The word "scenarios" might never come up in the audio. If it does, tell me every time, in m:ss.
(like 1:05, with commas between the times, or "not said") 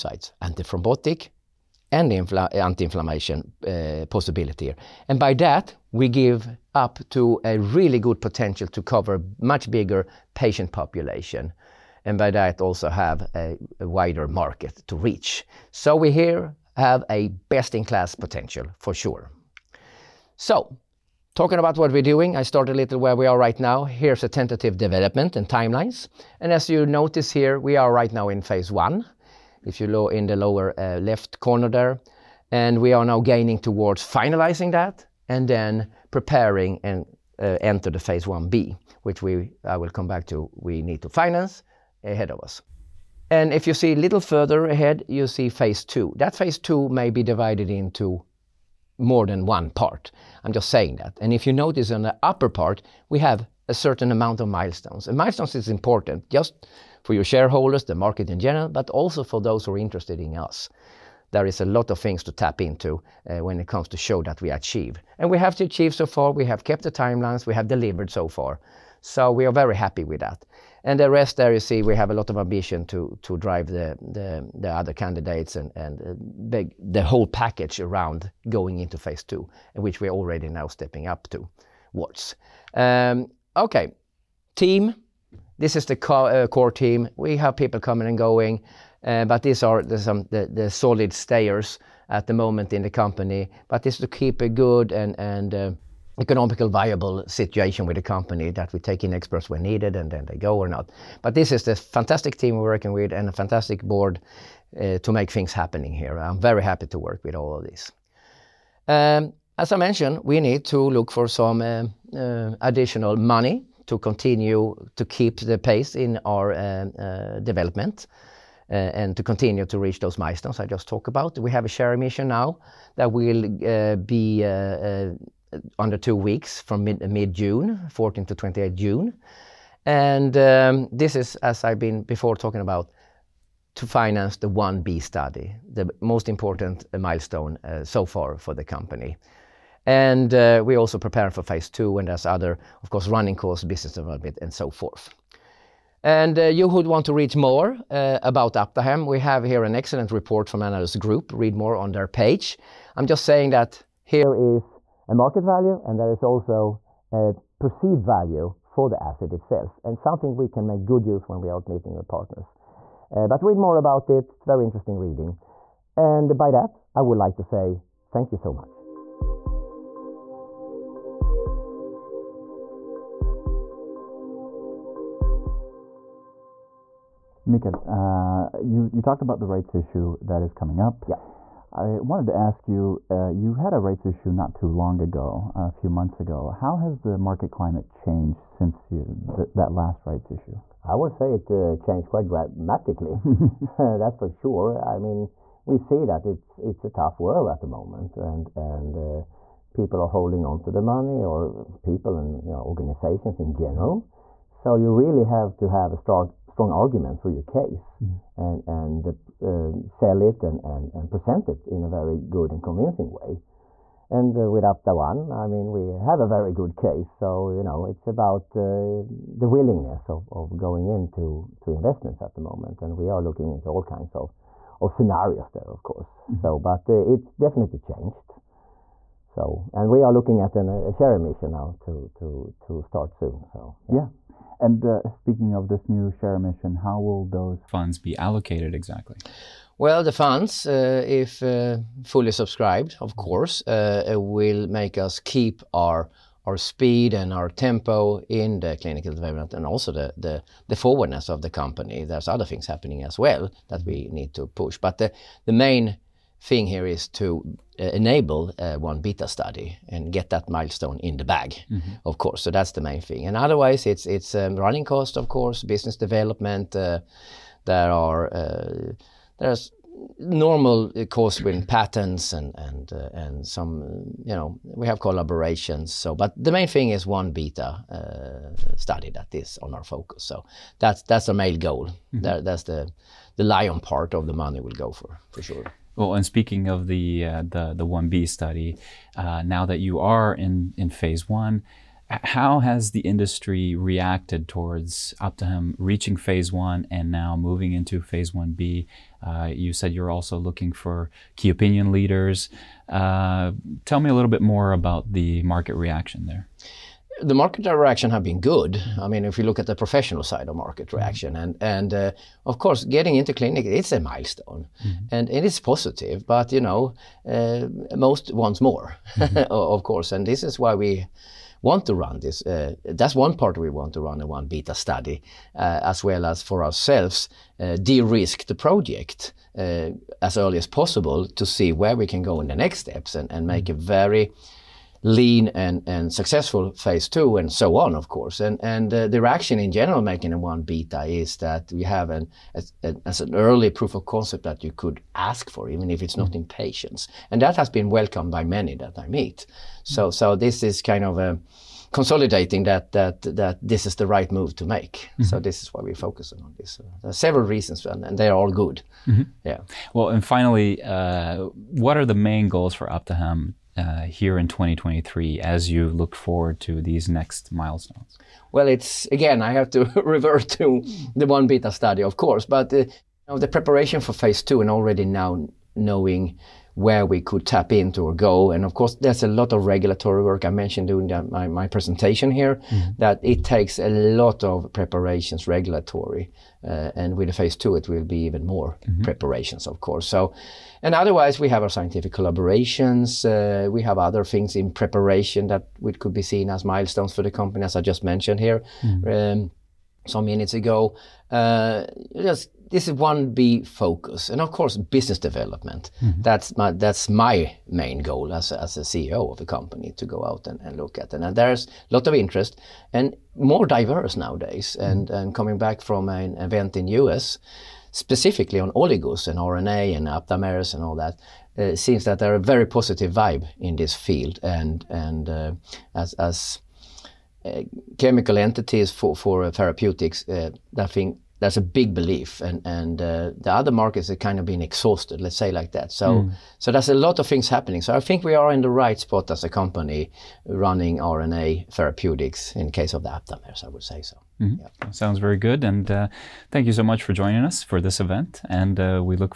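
3:44.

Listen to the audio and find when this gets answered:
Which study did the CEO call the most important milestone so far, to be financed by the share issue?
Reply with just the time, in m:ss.
2:14.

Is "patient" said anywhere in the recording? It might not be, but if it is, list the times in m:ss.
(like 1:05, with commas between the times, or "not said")
0:10, 5:46.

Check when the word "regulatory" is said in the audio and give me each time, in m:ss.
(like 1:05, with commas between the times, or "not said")
6:19, 6:25.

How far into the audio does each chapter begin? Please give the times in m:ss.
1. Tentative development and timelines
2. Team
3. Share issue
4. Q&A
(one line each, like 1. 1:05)
1. 0:19
2. 1:24
3. 1:49
4. 2:53.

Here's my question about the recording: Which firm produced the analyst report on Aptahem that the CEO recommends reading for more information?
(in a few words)
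Analyst Group.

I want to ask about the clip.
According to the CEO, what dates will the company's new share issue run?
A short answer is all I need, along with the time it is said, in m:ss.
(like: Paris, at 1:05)
14 to 28 June, at 2:07.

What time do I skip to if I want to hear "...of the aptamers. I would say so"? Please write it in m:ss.
7:22.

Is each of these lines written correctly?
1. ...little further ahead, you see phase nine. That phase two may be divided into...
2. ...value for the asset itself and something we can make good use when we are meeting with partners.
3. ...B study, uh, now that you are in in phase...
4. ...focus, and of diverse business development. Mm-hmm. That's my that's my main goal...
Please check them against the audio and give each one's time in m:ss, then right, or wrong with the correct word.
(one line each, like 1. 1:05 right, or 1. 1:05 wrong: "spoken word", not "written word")
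1. 0:44 wrong: "two", not "nine"
2. 2:38 right
3. 4:48 right
4. 6:43 wrong: "course", not "diverse".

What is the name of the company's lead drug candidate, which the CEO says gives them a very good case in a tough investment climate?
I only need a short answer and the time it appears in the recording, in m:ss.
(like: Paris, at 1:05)
Apta One, at 3:34.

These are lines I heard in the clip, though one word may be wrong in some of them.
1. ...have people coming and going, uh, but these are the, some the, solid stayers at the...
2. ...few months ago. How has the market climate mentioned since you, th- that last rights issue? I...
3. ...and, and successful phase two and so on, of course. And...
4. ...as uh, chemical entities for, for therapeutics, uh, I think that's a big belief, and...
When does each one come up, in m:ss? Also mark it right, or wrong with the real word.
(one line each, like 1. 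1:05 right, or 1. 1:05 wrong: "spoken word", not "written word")
1. 1:27 right
2. 3:05 wrong: "changed", not "mentioned"
3. 5:35 right
4. 7:06 right.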